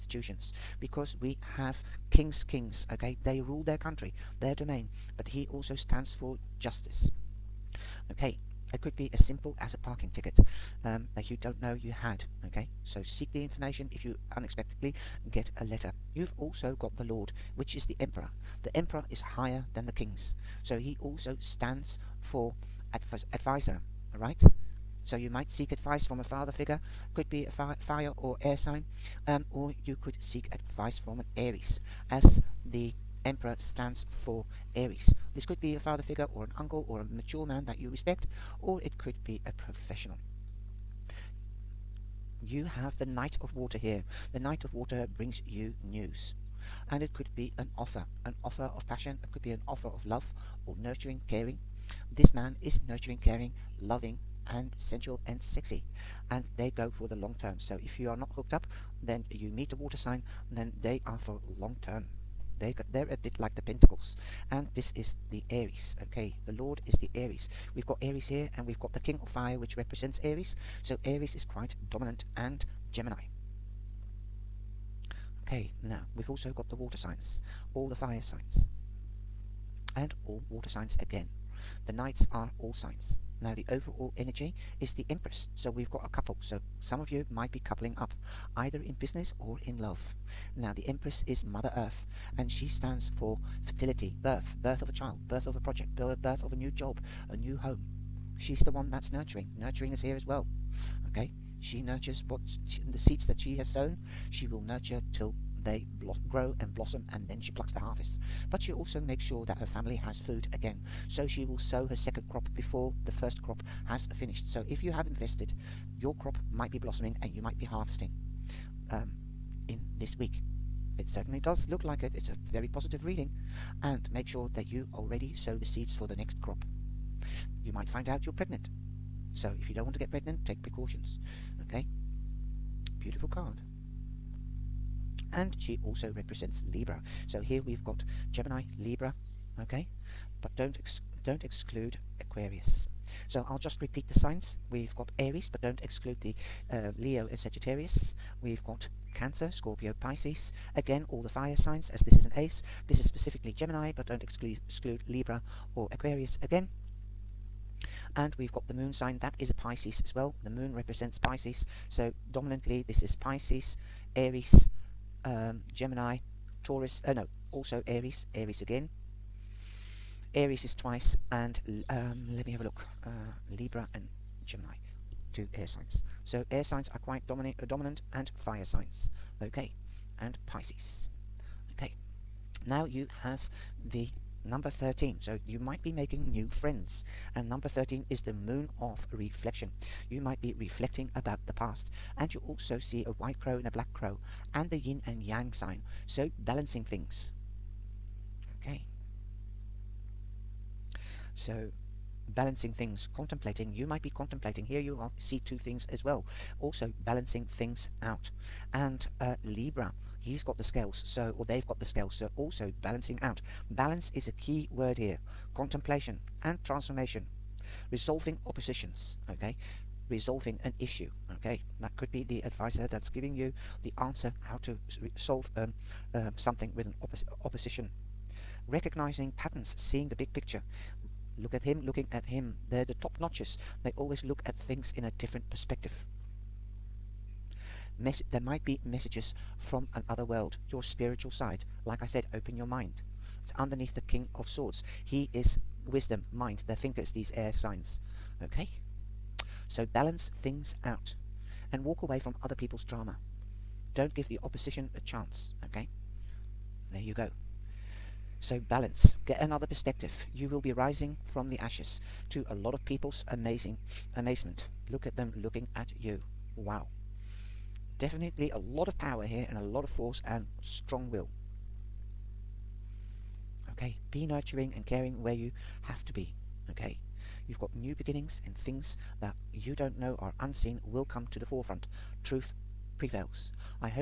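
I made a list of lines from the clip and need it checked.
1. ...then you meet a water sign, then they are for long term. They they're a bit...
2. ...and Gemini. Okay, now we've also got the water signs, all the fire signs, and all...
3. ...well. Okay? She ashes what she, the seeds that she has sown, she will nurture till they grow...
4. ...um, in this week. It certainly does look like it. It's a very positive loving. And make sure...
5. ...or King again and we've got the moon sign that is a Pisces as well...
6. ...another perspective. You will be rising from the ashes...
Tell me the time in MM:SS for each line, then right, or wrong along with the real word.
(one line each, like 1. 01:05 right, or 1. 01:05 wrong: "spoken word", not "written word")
1. 00:59 right
2. 01:12 right
3. 01:40 wrong: "nurtures", not "ashes"
4. 01:58 wrong: "reading", not "loving"
5. 02:35 wrong: "Aquarius", not "King"
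6. 04:19 right.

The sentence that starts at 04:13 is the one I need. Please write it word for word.
Don't give the opposition a chance, okay?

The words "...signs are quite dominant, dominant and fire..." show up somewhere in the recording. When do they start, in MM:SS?
02:56.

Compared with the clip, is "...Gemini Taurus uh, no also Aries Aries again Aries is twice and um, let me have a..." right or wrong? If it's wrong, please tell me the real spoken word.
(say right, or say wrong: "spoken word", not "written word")
right.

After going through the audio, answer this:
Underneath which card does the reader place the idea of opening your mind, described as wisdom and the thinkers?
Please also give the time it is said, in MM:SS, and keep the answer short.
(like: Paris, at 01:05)
King of Swords, at 04:04.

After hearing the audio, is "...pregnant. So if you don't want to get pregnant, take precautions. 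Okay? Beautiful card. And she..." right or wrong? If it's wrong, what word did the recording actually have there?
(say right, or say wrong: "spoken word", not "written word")
right.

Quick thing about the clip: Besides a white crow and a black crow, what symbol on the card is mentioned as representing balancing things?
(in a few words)
Yin and yang sign.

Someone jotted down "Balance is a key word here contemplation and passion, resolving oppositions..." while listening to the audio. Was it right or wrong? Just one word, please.
wrong.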